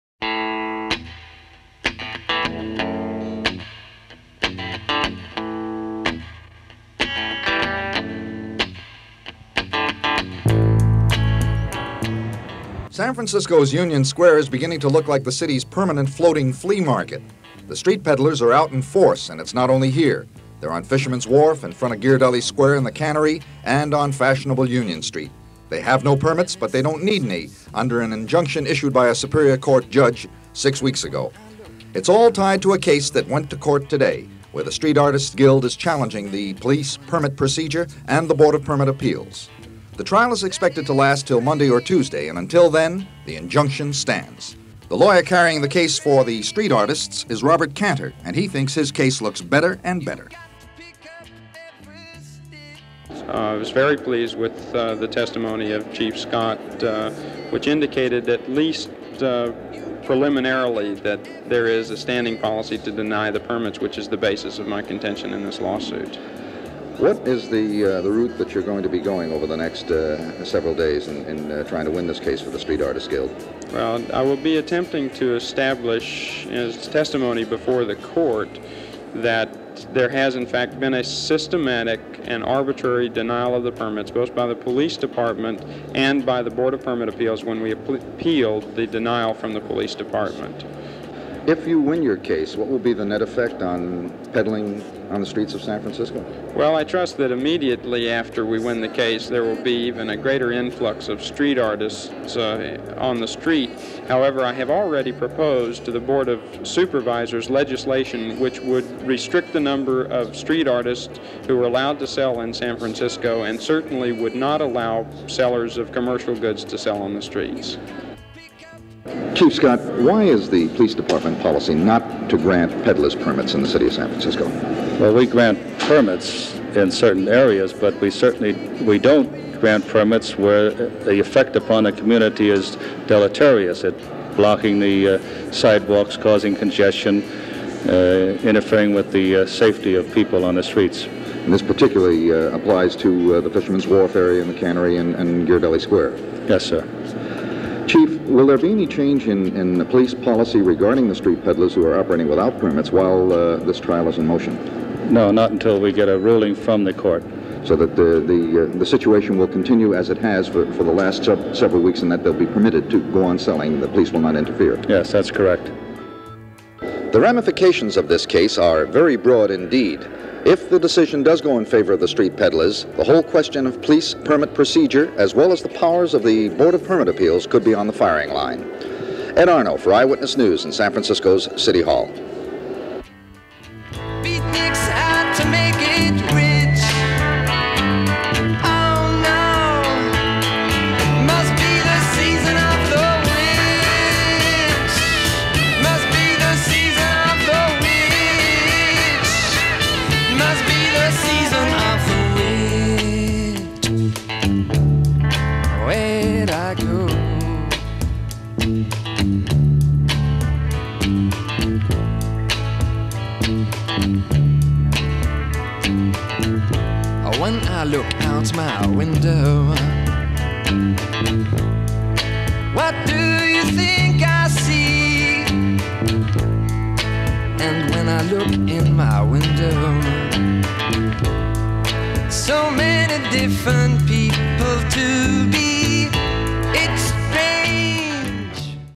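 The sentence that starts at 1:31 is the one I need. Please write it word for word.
If you win your case, what will be the net effect on peddling on the streets of San Francisco?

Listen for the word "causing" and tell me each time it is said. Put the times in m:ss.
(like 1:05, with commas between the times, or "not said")
2:16.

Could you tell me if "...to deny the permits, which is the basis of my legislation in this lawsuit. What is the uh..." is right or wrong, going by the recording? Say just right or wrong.
wrong.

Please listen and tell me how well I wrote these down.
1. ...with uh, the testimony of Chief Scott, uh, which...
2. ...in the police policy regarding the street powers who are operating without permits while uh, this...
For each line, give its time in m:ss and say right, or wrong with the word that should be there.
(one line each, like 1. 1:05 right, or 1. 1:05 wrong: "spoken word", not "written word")
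1. 0:54 right
2. 2:29 wrong: "peddlers", not "powers".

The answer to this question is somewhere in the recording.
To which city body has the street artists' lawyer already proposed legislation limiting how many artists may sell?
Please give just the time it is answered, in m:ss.
1:45.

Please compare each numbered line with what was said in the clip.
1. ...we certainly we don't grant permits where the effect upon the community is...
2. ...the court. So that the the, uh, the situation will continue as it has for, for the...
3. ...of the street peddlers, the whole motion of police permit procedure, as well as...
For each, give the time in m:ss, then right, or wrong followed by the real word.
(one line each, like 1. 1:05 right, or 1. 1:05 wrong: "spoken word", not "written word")
1. 2:07 right
2. 2:36 right
3. 2:51 wrong: "question", not "motion".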